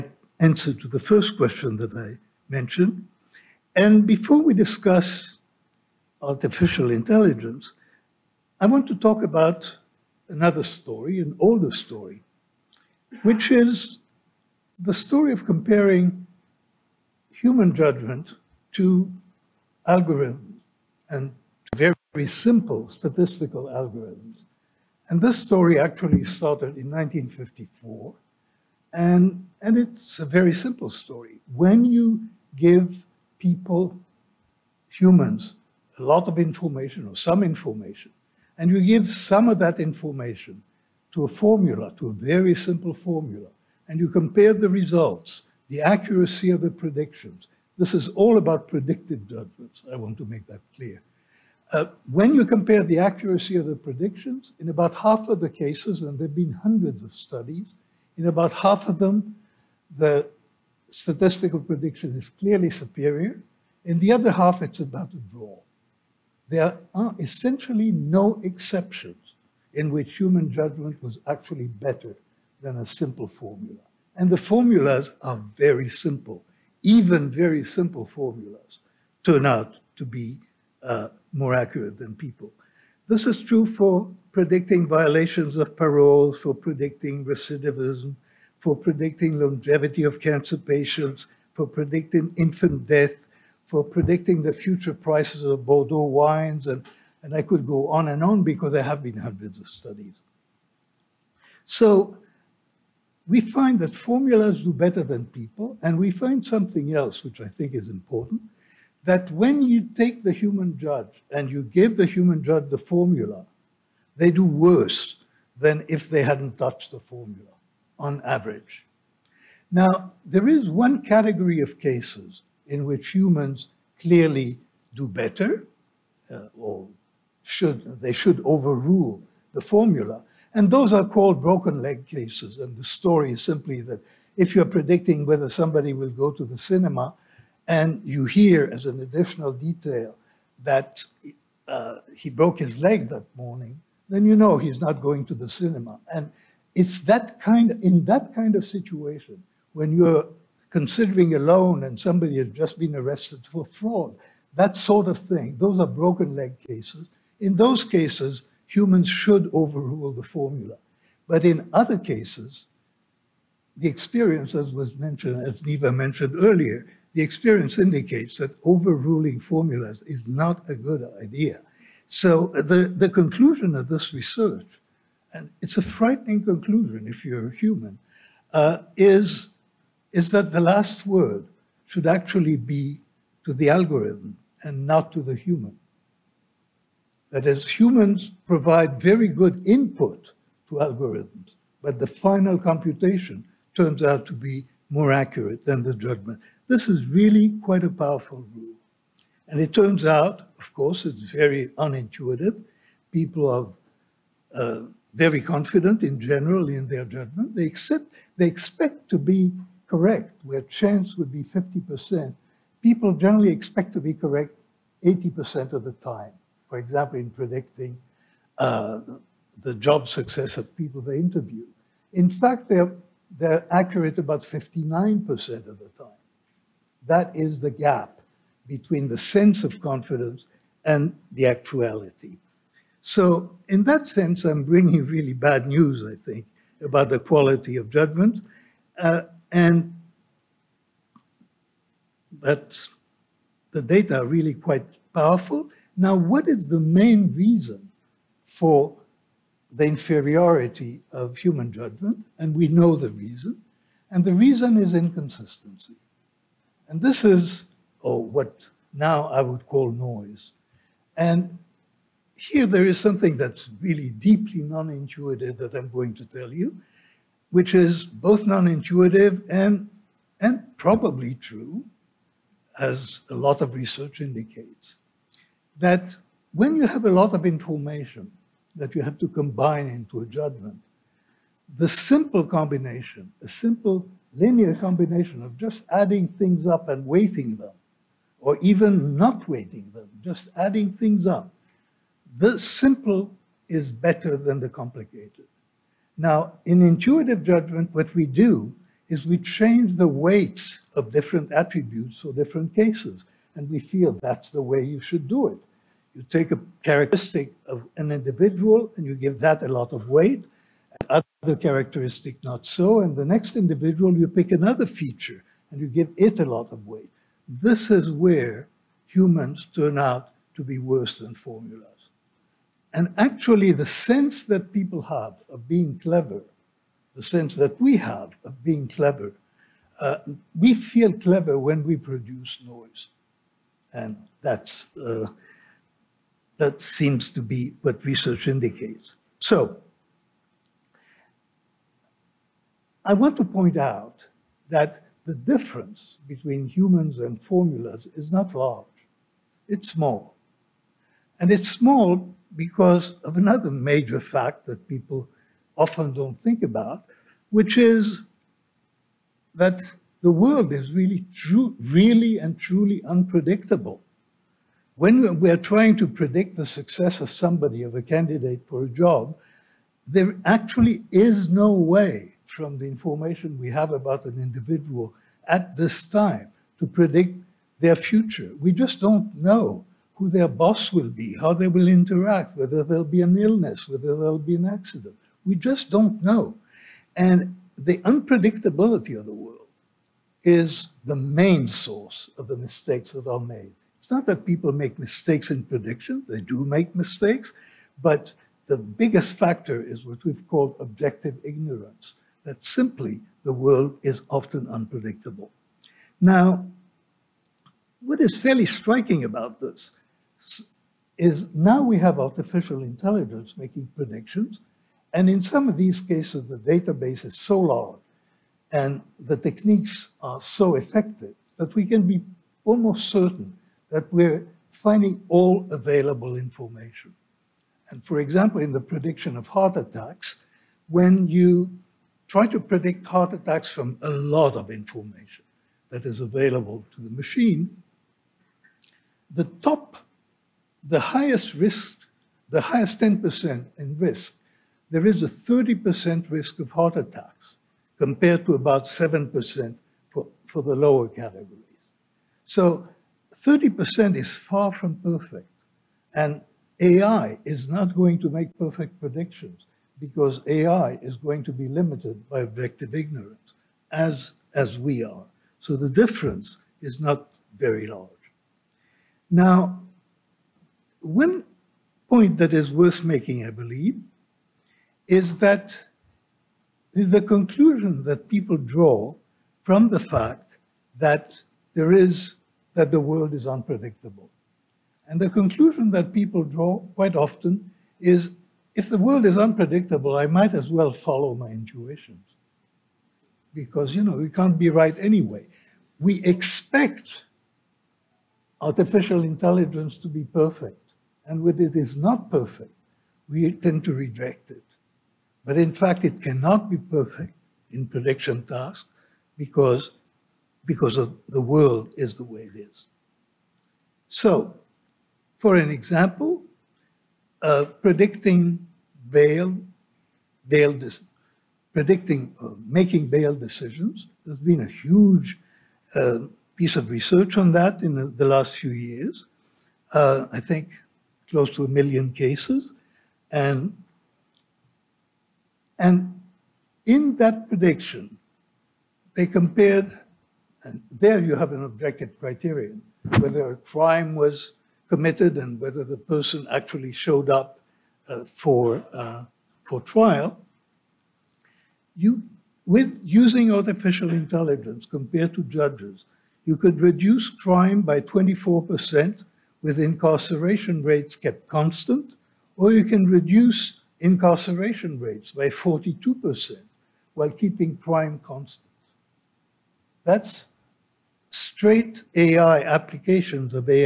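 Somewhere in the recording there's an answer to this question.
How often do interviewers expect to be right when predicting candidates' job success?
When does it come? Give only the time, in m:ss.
3:35.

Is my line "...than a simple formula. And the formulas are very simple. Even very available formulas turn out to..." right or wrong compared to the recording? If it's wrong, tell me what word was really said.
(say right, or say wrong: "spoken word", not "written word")
wrong: "simple", not "available".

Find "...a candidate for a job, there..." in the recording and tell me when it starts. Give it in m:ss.
6:07.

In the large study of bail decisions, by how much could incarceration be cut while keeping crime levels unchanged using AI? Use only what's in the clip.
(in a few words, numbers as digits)
42%.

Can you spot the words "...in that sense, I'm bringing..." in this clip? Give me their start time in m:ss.
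3:53.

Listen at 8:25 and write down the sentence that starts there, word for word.
But in fact, it cannot be perfect in prediction tasks because, because of the world is the way it is.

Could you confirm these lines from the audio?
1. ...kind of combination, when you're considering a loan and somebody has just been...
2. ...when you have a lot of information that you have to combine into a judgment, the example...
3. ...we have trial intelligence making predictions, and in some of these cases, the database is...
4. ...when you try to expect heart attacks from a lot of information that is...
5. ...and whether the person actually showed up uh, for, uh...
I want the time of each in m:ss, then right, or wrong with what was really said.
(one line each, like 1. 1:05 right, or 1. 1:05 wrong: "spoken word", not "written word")
1. 2:28 wrong: "situation", not "combination"
2. 4:36 wrong: "simple", not "example"
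3. 6:51 wrong: "artificial", not "trial"
4. 7:10 wrong: "predict", not "expect"
5. 9:05 right.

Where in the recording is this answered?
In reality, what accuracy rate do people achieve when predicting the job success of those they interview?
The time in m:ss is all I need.
3:44.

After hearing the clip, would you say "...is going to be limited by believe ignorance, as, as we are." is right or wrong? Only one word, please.
wrong.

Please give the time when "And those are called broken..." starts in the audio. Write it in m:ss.
2:10.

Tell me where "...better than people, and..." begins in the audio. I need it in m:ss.
1:44.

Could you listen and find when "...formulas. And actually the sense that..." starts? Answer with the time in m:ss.
5:21.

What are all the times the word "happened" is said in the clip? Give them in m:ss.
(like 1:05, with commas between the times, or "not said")
not said.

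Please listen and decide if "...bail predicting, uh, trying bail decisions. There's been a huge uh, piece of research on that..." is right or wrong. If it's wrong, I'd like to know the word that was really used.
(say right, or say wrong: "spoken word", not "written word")
wrong: "making", not "trying".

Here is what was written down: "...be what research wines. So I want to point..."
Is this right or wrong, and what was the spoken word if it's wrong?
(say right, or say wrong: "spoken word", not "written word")
wrong: "indicates", not "wines".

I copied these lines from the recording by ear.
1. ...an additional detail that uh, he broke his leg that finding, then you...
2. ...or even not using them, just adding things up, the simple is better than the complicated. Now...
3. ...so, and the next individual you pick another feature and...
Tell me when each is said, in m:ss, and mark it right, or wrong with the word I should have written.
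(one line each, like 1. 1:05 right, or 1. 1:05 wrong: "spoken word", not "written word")
1. 2:18 wrong: "morning", not "finding"
2. 4:48 wrong: "weighting", not "using"
3. 5:12 right.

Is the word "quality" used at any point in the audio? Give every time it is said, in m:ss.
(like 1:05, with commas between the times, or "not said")
3:57.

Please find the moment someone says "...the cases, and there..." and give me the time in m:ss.
0:55.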